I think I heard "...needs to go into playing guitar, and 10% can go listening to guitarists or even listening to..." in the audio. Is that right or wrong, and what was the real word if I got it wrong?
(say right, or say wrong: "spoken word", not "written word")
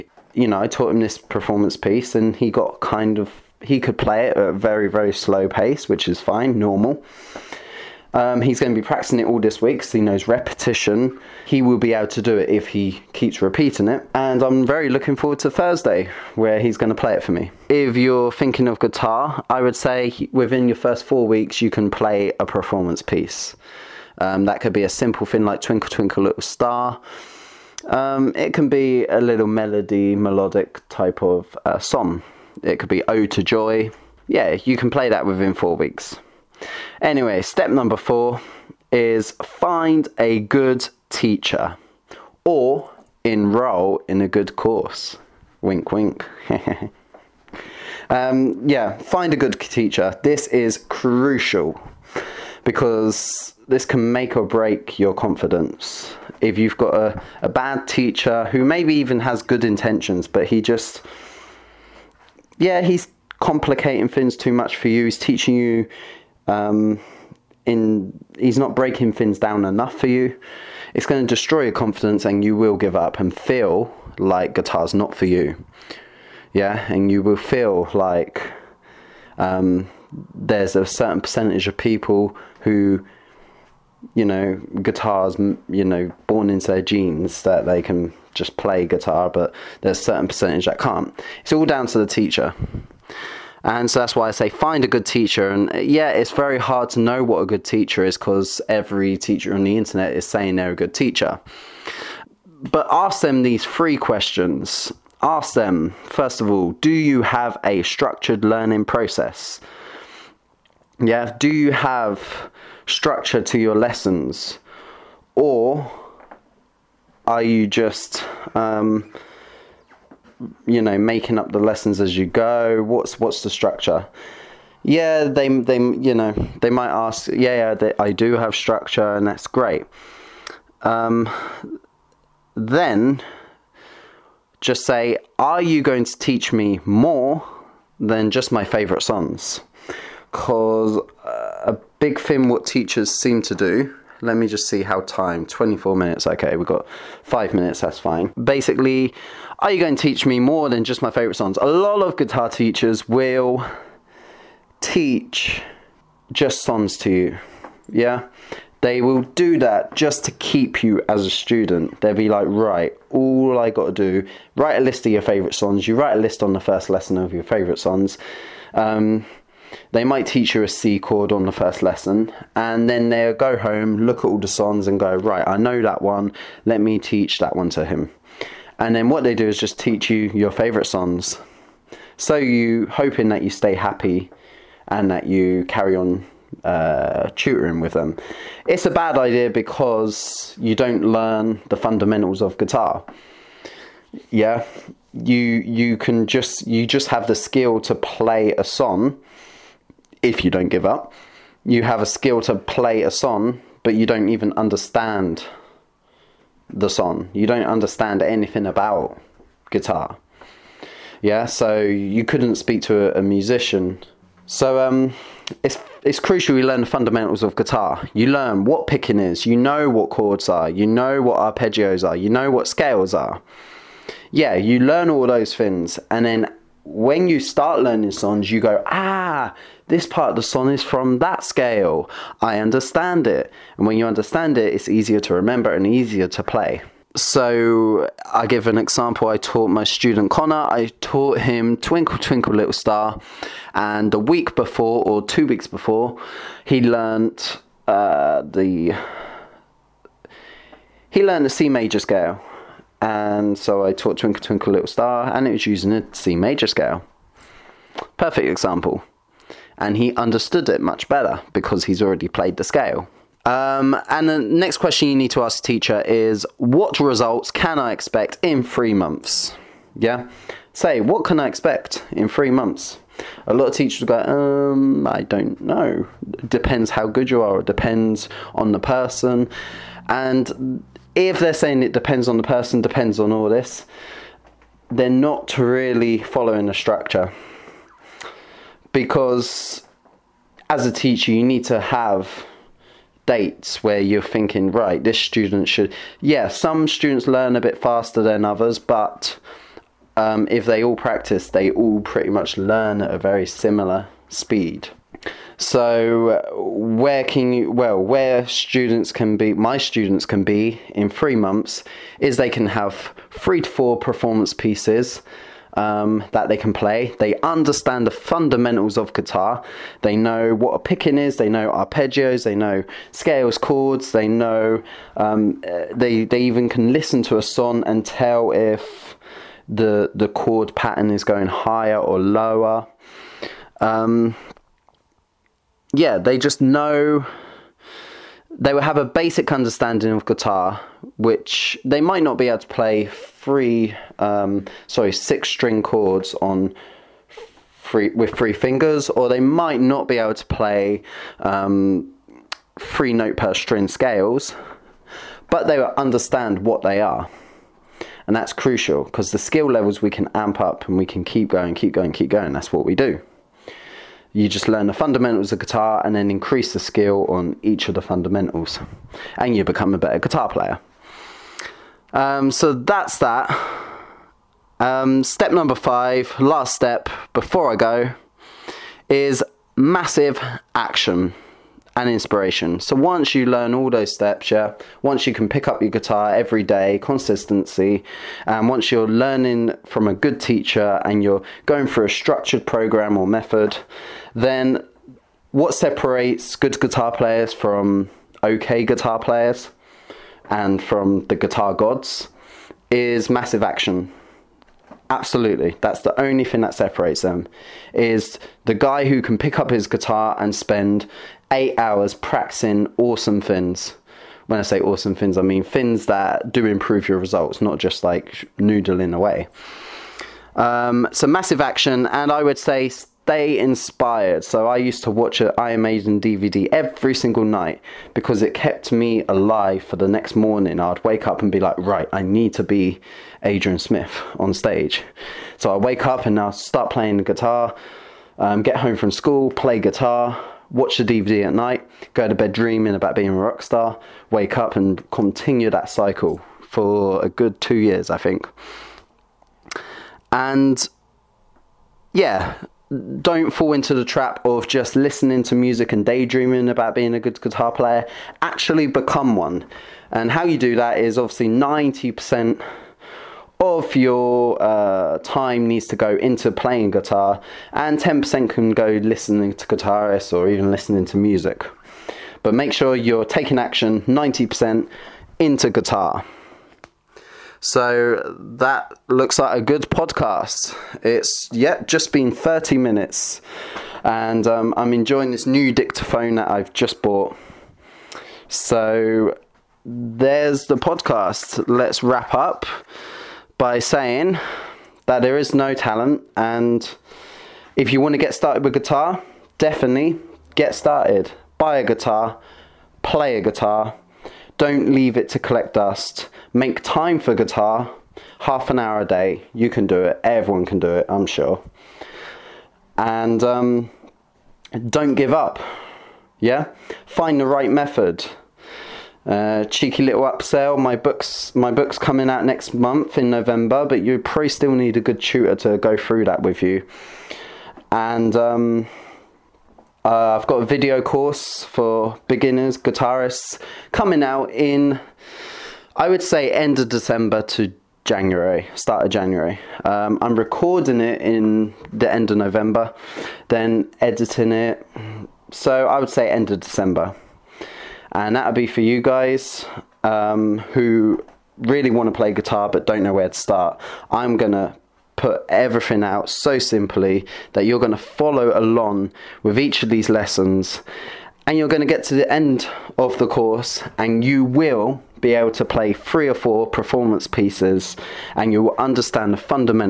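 right.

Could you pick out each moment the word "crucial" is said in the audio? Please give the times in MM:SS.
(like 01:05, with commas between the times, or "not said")
00:50, 03:36, 05:58.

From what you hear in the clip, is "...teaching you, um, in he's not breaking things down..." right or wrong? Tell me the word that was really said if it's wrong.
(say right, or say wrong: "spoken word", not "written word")
right.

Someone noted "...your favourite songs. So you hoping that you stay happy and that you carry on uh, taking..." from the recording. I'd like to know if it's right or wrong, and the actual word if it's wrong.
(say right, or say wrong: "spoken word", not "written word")
wrong: "tutoring", not "taking".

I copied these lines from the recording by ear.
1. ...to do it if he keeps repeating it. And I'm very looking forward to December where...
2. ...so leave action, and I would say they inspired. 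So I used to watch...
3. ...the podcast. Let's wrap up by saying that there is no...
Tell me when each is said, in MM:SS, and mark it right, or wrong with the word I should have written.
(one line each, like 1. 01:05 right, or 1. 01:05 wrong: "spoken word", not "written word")
1. 00:12 wrong: "Thursday", not "December"
2. 07:01 wrong: "massive", not "leave"
3. 08:10 right.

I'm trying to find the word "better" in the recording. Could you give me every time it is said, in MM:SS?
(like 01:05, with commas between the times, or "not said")
04:21, 06:09.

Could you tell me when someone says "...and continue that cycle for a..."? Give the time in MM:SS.
07:24.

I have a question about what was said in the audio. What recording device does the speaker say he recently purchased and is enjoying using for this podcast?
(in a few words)
dictaphone.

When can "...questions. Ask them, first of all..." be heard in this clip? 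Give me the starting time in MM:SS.
01:43.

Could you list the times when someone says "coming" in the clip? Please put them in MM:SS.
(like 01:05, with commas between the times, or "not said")
08:41, 08:53.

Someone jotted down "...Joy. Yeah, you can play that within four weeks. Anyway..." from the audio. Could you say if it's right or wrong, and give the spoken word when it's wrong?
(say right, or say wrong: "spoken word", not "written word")
right.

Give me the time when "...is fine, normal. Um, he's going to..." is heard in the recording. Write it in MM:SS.
00:06.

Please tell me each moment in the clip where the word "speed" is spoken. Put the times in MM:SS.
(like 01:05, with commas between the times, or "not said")
05:04.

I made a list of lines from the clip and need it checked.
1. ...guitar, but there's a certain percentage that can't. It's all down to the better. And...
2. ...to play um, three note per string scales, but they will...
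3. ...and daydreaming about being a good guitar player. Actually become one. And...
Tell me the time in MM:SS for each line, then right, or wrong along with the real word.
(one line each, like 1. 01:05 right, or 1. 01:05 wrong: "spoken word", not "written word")
1. 01:28 wrong: "teacher", not "better"
2. 05:50 right
3. 07:35 right.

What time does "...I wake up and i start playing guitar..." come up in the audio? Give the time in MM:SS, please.
07:15.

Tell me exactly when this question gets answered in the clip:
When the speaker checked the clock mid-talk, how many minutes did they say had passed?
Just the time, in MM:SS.
02:25.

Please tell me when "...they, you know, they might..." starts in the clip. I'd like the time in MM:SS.
02:05.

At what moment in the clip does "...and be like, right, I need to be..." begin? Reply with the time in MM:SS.
07:11.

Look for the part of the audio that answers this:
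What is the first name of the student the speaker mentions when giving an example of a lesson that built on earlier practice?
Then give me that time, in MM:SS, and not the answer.
04:00.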